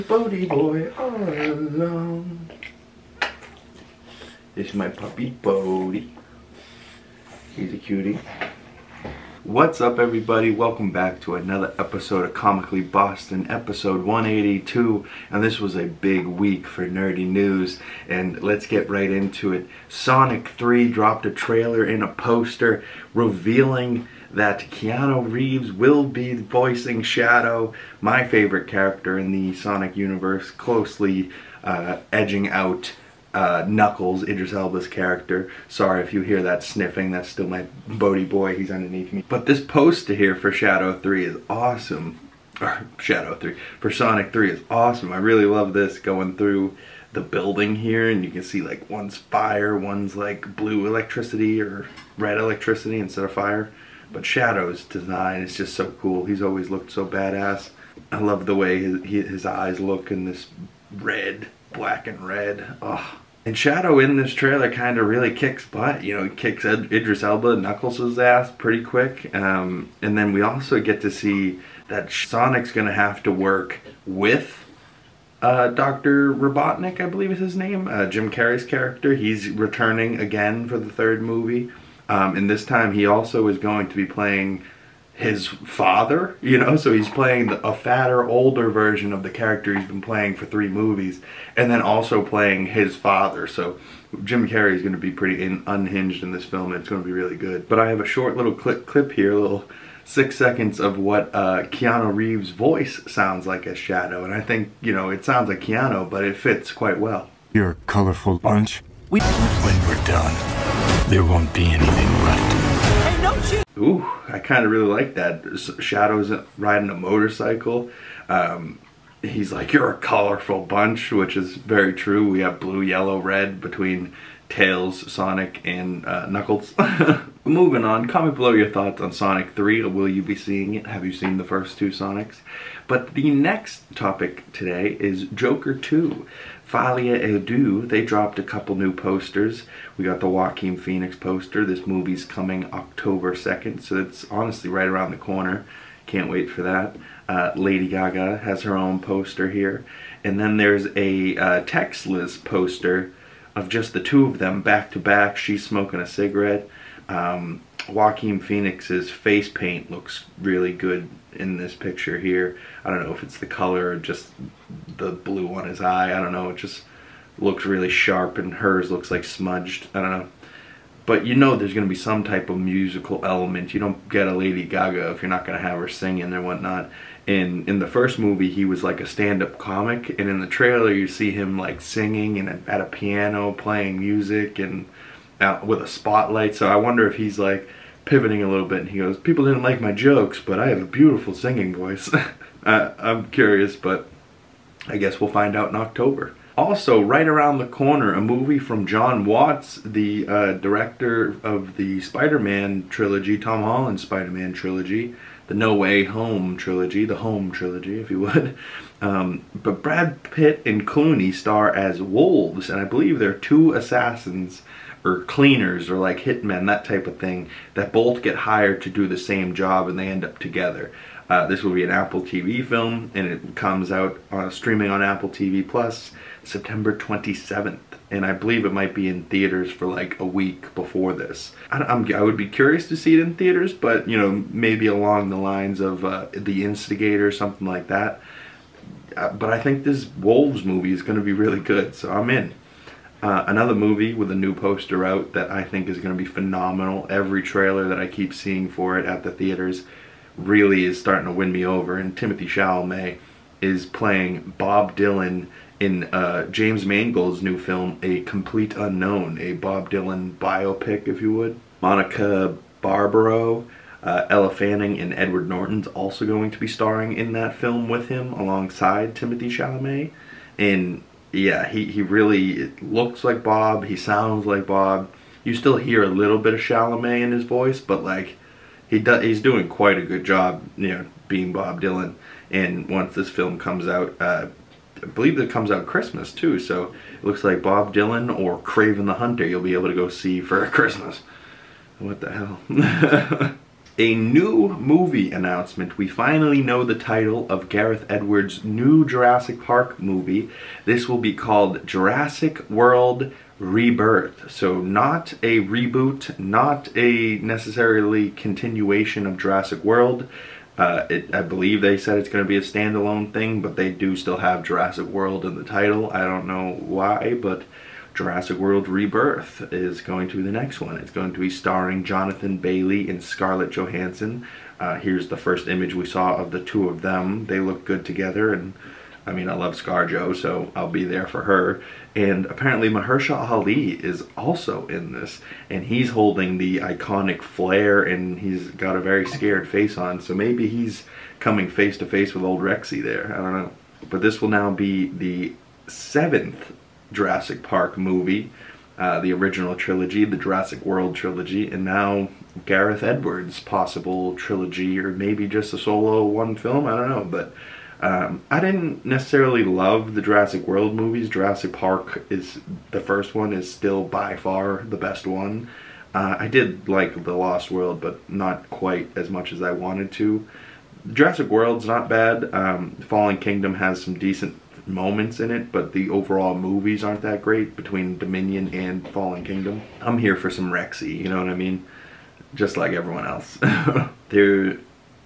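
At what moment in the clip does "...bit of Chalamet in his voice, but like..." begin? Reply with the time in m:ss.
4:36.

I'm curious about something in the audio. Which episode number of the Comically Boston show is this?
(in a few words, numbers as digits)
182.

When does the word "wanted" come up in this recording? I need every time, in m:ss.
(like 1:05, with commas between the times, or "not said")
6:09.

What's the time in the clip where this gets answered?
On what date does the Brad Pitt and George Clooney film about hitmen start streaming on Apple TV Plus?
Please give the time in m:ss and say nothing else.
3:46.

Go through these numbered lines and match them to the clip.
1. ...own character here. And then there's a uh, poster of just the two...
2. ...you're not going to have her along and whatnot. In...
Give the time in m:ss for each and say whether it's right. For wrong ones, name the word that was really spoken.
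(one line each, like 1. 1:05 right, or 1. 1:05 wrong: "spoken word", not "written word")
1. 2:28 wrong: "poster", not "character"
2. 2:55 wrong: "singing", not "along".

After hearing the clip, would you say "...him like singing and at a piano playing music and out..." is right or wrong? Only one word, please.
right.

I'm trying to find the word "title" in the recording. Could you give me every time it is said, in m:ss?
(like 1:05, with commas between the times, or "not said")
4:56, 5:15.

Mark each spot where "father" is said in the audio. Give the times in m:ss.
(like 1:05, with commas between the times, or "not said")
1:25, 1:32.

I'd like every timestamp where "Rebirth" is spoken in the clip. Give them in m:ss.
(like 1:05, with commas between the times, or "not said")
5:03, 5:18.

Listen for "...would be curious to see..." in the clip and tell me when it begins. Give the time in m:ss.
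3:52.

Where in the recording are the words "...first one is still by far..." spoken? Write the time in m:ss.
6:03.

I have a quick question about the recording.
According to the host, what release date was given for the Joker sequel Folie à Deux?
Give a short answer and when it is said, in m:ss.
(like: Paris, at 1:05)
October 2nd, at 2:22.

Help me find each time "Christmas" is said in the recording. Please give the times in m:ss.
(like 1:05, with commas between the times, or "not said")
4:45, 4:50.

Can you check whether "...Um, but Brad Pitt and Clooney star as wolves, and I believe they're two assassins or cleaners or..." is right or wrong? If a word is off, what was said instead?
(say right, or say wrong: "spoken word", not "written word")
right.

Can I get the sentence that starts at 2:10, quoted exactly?
Have you seen the first two Sonics?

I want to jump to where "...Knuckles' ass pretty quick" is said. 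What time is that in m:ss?
1:07.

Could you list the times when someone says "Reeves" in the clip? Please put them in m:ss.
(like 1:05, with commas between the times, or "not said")
0:25, 1:42.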